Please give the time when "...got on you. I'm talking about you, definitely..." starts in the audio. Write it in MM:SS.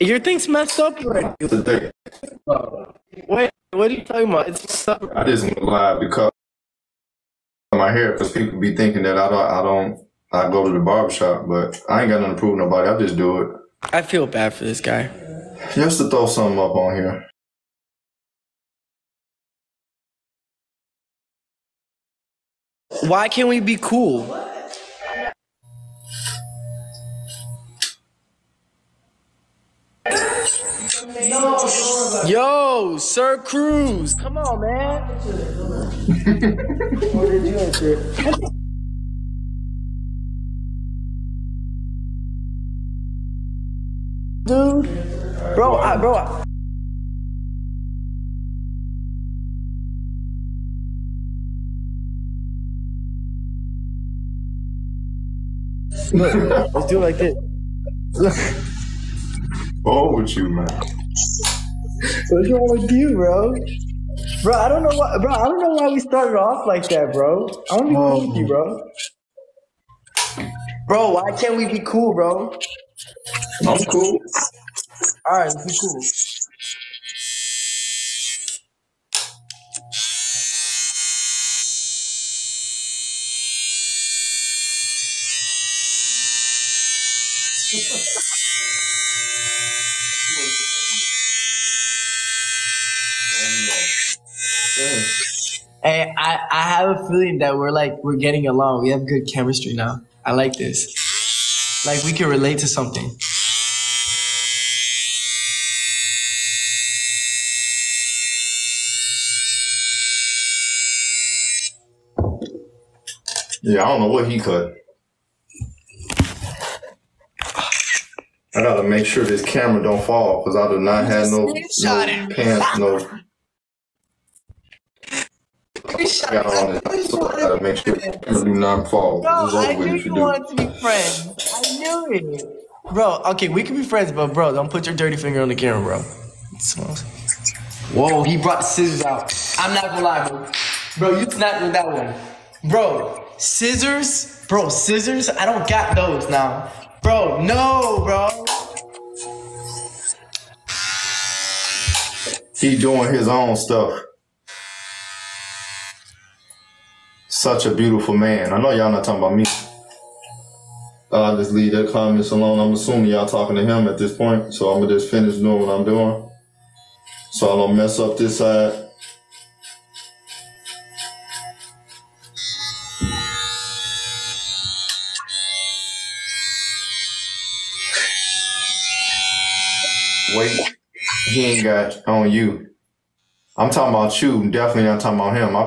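03:01.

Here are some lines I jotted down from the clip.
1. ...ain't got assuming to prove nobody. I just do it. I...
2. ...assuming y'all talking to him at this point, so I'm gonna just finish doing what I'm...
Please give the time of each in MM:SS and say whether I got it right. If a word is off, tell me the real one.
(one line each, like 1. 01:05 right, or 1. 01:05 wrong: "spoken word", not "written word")
1. 00:12 wrong: "nothing", not "assuming"
2. 02:42 right.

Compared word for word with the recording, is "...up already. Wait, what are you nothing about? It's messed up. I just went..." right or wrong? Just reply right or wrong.
wrong.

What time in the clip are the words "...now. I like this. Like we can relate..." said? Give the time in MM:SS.
01:39.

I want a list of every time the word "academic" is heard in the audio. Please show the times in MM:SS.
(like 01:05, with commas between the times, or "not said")
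not said.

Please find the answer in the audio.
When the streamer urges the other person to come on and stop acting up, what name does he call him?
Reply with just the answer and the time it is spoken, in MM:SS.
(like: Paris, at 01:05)
Sir Cruz, at 00:32.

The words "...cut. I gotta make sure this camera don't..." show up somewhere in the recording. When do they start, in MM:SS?
01:54.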